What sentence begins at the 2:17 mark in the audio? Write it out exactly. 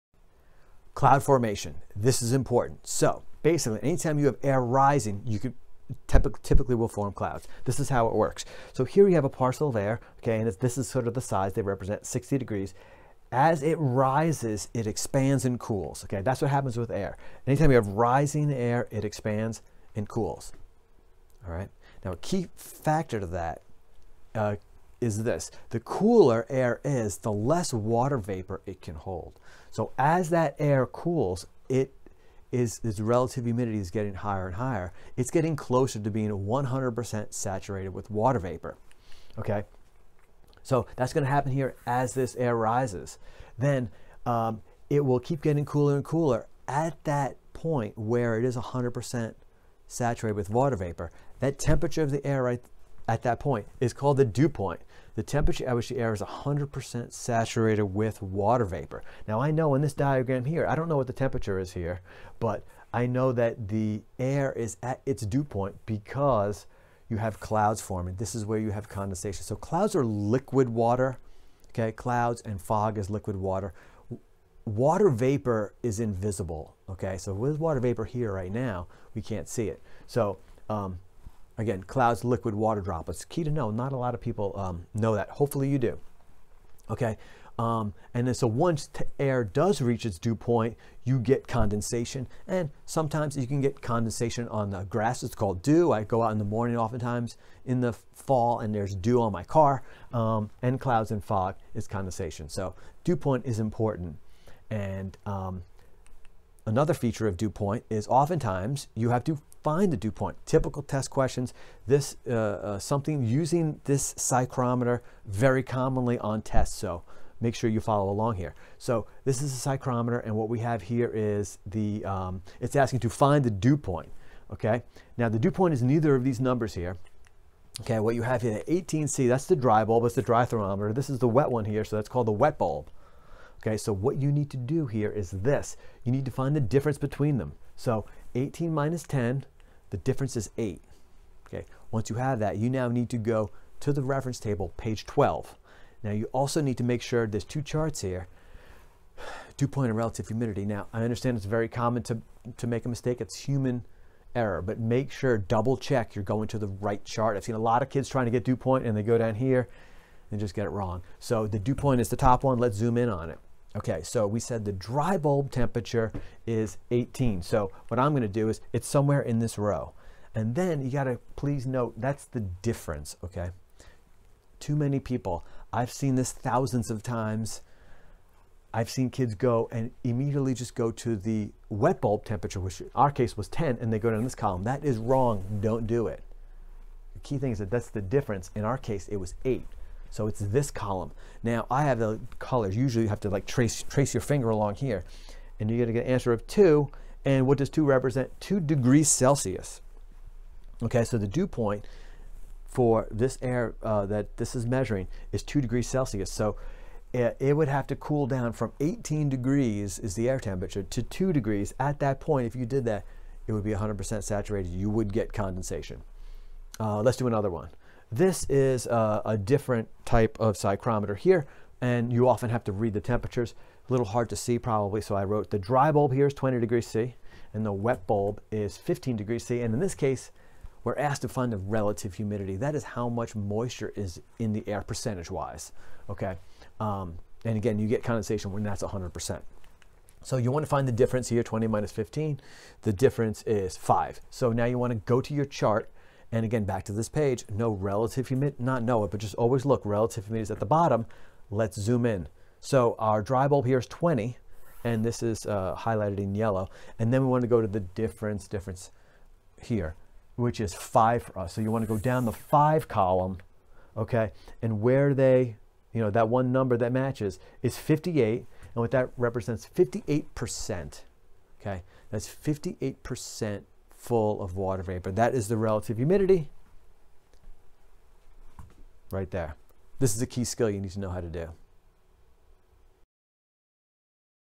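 So 18 minus 10, the difference is 8.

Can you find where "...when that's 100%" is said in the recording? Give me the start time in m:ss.
3:58.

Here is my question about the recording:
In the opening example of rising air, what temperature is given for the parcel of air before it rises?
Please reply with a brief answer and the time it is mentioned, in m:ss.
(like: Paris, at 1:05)
60 degrees, at 0:12.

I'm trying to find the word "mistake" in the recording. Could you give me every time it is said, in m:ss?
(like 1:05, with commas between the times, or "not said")
2:32.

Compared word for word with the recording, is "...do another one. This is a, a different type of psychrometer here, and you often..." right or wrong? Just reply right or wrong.
right.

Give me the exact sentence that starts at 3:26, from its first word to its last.
So it, eh, it, would have to cool down from 18 degrees is the air temperature to two degrees.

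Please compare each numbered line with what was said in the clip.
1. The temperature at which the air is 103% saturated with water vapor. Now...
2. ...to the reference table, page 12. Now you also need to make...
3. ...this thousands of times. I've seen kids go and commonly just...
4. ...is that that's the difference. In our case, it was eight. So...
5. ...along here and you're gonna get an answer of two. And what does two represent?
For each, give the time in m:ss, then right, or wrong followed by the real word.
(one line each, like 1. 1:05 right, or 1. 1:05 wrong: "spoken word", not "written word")
1. 0:55 wrong: "100", not "103"
2. 2:23 right
3. 2:56 wrong: "immediately", not "commonly"
4. 3:07 right
5. 3:14 right.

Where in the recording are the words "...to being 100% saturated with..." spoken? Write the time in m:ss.
0:35.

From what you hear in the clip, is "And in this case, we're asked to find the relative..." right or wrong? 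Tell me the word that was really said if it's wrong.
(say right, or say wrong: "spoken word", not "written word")
right.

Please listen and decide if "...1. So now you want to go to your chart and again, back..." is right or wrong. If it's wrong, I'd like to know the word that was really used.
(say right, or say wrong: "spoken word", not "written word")
wrong: "5", not "1".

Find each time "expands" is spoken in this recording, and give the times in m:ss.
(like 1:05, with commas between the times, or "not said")
0:14, 0:19.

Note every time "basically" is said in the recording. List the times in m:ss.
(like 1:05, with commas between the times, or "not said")
0:03.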